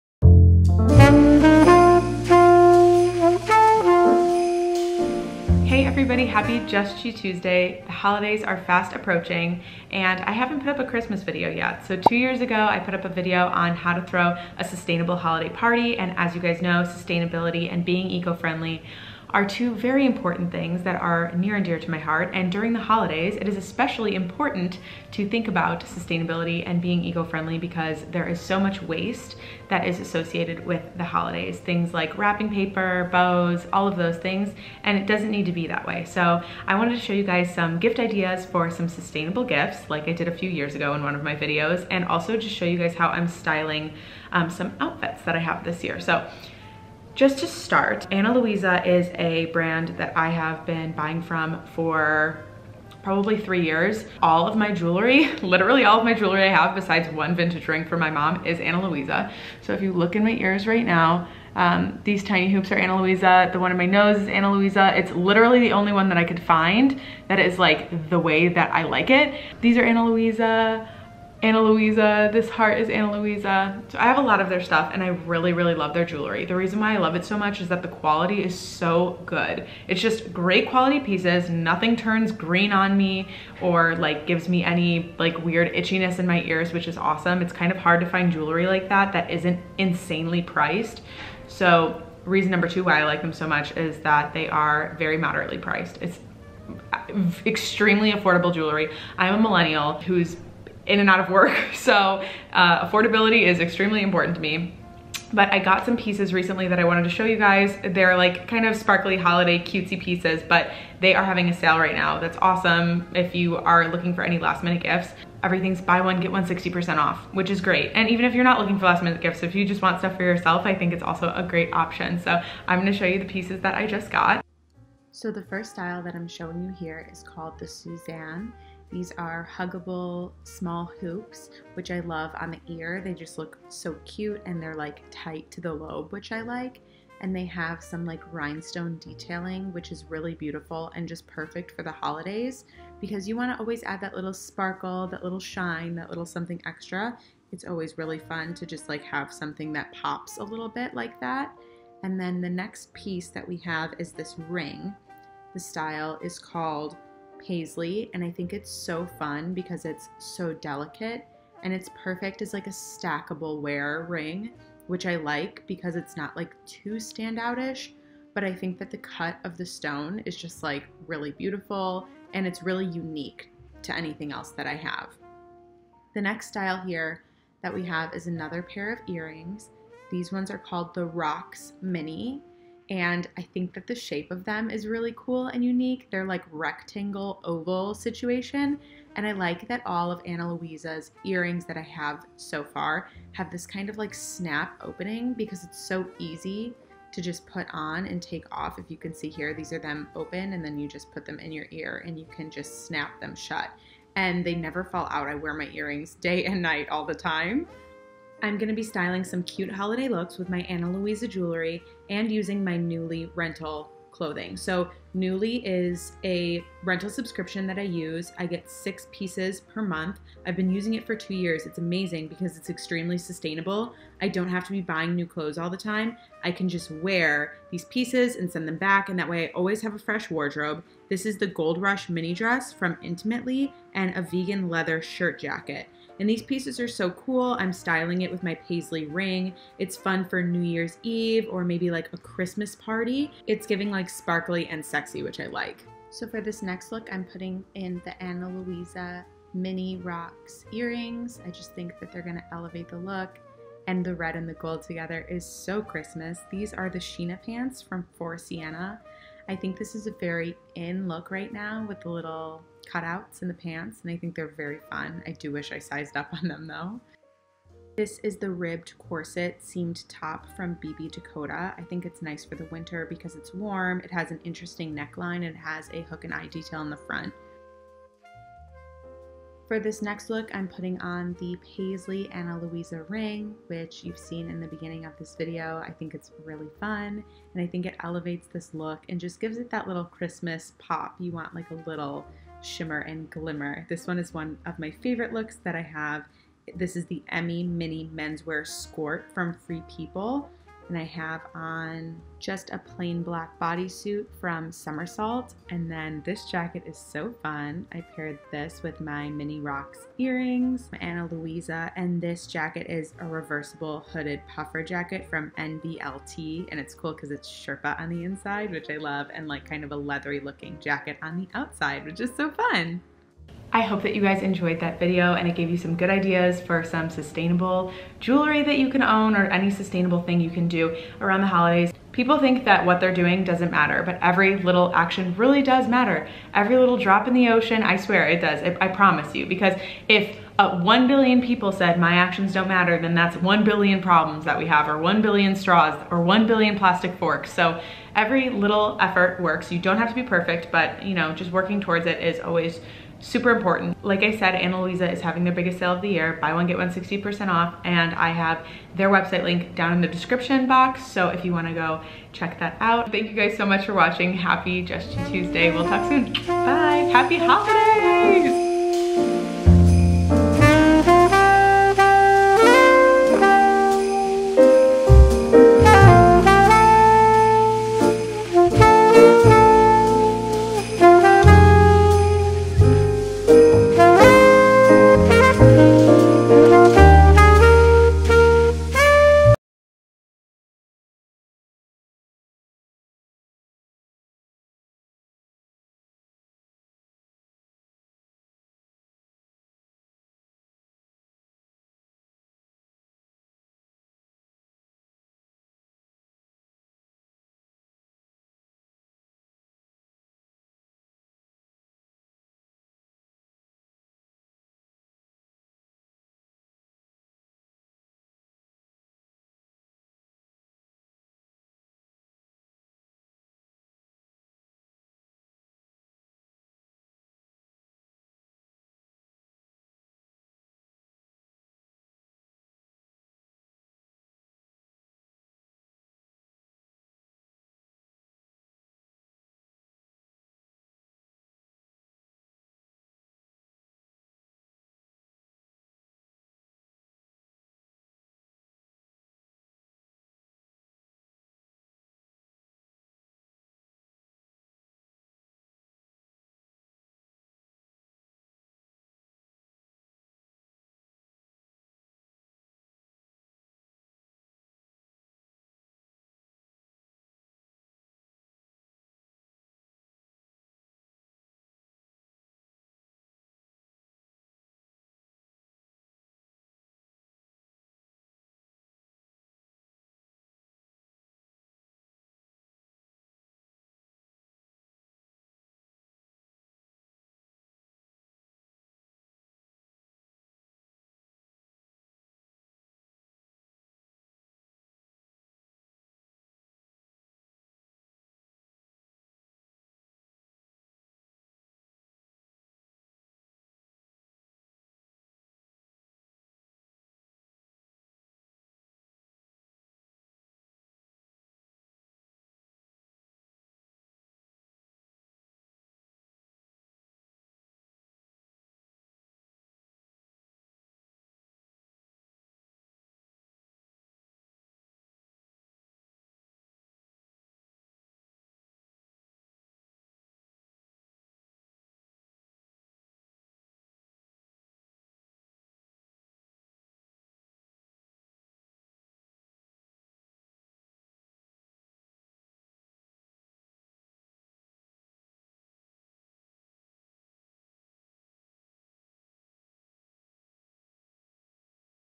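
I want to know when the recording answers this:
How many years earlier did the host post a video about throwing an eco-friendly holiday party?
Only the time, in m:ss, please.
0:11.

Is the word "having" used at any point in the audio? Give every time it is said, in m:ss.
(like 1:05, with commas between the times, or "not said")
1:51, 5:55.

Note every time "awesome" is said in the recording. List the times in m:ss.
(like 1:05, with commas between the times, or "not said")
1:26, 1:52.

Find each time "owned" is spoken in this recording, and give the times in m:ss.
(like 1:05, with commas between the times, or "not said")
not said.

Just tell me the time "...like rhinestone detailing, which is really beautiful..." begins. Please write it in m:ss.
2:18.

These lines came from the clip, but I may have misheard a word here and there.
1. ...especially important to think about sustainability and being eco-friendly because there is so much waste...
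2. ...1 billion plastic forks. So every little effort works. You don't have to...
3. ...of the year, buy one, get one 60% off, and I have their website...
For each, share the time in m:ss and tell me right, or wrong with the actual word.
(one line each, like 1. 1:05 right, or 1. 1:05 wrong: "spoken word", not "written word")
1. 0:23 right
2. 5:46 right
3. 5:55 right.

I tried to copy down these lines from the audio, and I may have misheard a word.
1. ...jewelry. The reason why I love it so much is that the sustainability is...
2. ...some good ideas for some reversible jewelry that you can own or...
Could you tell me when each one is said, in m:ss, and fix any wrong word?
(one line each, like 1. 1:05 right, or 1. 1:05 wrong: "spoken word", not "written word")
1. 1:16 wrong: "quality", not "sustainability"
2. 5:25 wrong: "sustainable", not "reversible".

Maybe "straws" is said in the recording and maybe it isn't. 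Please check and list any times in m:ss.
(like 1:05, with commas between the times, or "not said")
5:45.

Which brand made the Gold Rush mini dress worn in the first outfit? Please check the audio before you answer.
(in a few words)
Intimately.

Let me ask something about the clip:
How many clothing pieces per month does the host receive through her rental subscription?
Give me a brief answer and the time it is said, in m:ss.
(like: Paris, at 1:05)
6, at 3:38.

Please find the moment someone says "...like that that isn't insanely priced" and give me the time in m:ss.
1:28.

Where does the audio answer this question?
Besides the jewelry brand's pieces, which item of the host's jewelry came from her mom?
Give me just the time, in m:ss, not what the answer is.
0:57.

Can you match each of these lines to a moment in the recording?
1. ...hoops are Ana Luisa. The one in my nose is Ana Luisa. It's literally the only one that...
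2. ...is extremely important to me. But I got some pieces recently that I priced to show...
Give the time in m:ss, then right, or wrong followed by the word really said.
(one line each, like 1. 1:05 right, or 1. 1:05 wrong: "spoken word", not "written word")
1. 1:02 right
2. 1:43 wrong: "wanted", not "priced".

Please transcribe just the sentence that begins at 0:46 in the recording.
So just to start, Ana Luisa is a brand that I have been buying from for probably three years.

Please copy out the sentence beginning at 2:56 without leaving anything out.
The next style here that we have is another pair of earrings.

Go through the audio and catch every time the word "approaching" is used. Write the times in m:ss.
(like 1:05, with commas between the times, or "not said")
0:08.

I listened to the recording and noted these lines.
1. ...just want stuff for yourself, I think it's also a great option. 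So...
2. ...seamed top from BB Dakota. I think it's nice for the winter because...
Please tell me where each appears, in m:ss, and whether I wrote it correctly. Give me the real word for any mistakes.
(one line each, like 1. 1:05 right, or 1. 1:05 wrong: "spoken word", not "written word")
1. 1:59 right
2. 4:29 right.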